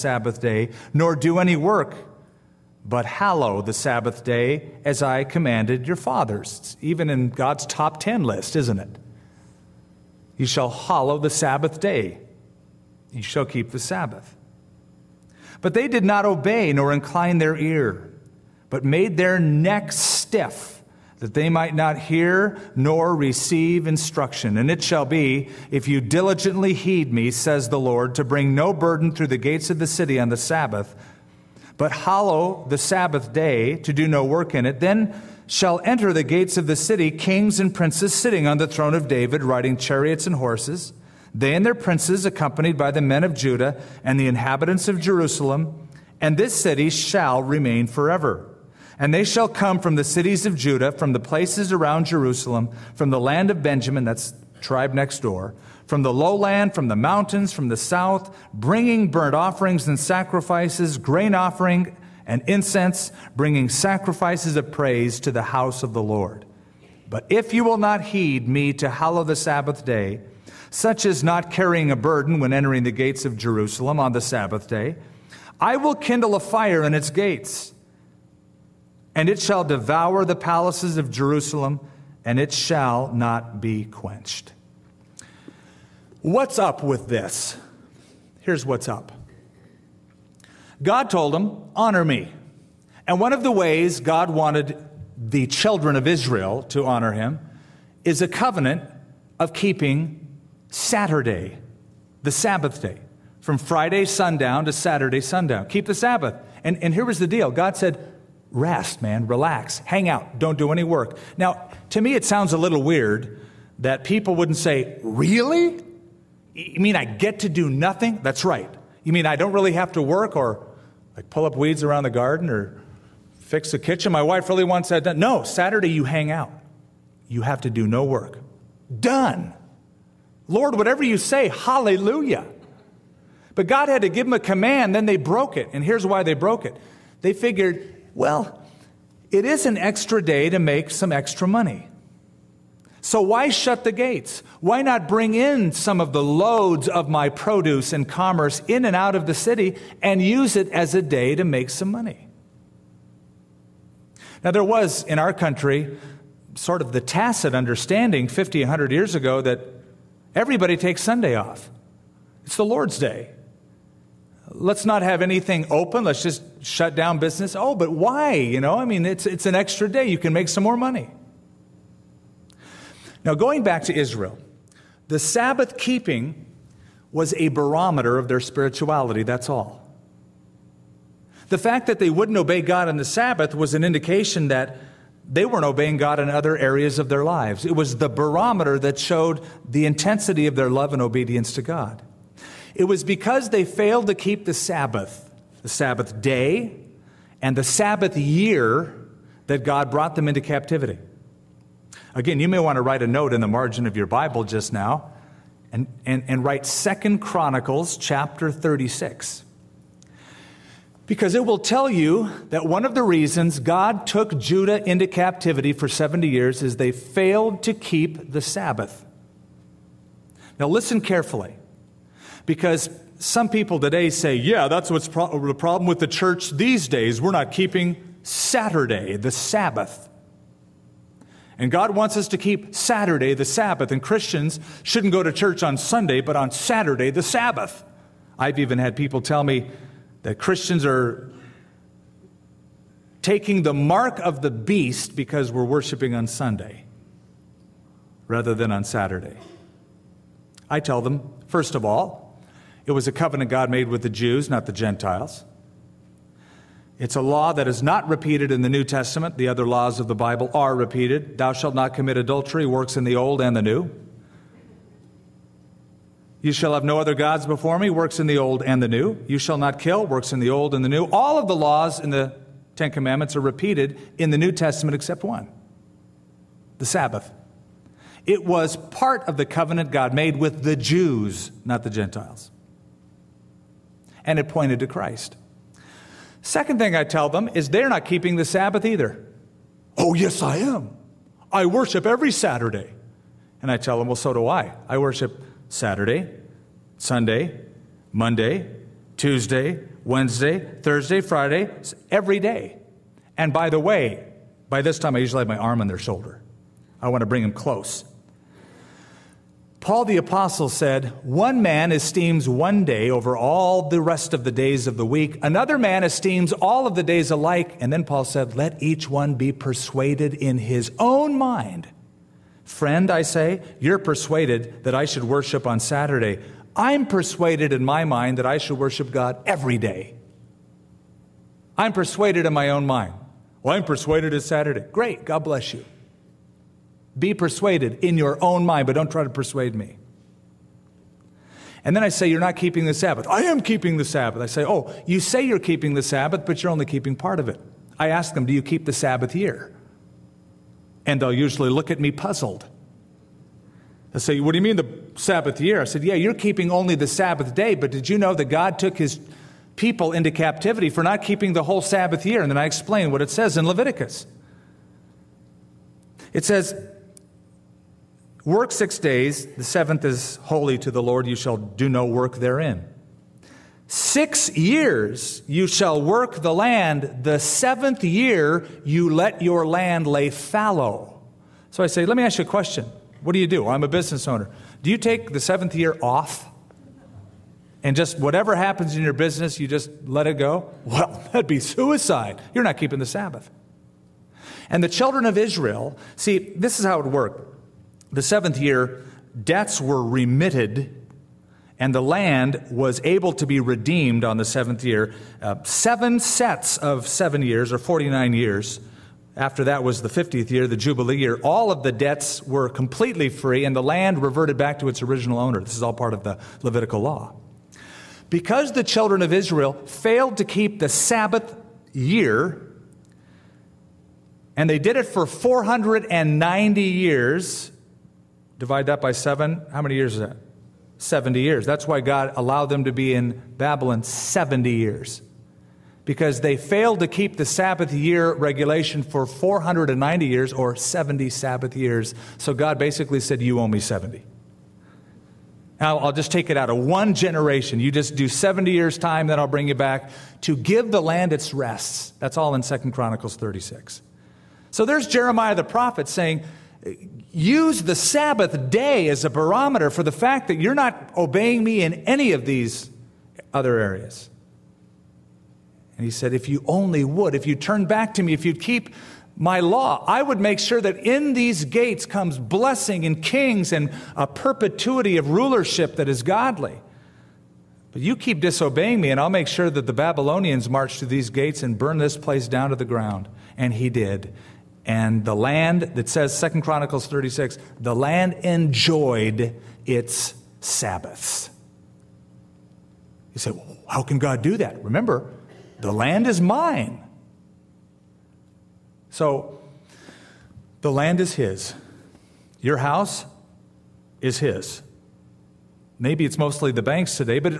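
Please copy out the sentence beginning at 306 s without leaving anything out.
I want to bring them close.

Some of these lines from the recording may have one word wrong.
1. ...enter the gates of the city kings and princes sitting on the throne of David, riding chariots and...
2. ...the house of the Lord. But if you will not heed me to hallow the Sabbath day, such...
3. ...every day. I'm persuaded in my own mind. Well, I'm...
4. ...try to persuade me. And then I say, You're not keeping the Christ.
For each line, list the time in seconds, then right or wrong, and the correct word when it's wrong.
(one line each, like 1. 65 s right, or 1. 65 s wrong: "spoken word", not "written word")
1. 35 s right
2. 65 s right
3. 329 s right
4. 339 s wrong: "Sabbath", not "Christ".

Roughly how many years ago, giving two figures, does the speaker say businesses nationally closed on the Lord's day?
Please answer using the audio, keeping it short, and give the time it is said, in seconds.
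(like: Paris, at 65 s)
50, 100 years, at 158 s.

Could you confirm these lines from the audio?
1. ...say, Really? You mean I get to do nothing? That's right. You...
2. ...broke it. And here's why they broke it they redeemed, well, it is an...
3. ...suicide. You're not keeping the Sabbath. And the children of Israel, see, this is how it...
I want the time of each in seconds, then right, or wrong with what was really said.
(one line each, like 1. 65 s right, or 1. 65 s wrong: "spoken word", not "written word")
1. 114 s right
2. 135 s wrong: "figured", not "redeemed"
3. 391 s right.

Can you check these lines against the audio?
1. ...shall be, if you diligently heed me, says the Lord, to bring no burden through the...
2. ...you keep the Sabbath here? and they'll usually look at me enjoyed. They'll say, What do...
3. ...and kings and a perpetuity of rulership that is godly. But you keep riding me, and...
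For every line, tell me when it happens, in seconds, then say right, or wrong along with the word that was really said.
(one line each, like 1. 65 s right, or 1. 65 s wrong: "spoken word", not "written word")
1. 24 s right
2. 348 s wrong: "puzzled", not "enjoyed"
3. 473 s wrong: "disobeying", not "riding".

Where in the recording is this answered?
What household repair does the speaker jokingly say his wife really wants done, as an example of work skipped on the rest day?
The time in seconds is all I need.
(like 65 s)
123 s.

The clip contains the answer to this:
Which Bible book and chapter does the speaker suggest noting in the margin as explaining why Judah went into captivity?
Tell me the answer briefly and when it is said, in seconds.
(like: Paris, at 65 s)
Second Chronicles 36, at 206 s.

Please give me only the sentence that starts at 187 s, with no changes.
It was the barometer that showed the intensity of their love and obedience to God.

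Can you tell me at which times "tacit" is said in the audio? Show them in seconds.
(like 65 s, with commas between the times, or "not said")
156 s.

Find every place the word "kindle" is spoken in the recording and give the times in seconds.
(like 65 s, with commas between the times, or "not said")
75 s.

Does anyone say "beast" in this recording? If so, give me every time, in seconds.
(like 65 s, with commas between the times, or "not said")
244 s.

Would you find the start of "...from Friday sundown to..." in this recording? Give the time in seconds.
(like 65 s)
103 s.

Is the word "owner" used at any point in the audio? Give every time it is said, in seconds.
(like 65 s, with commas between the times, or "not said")
384 s, 415 s.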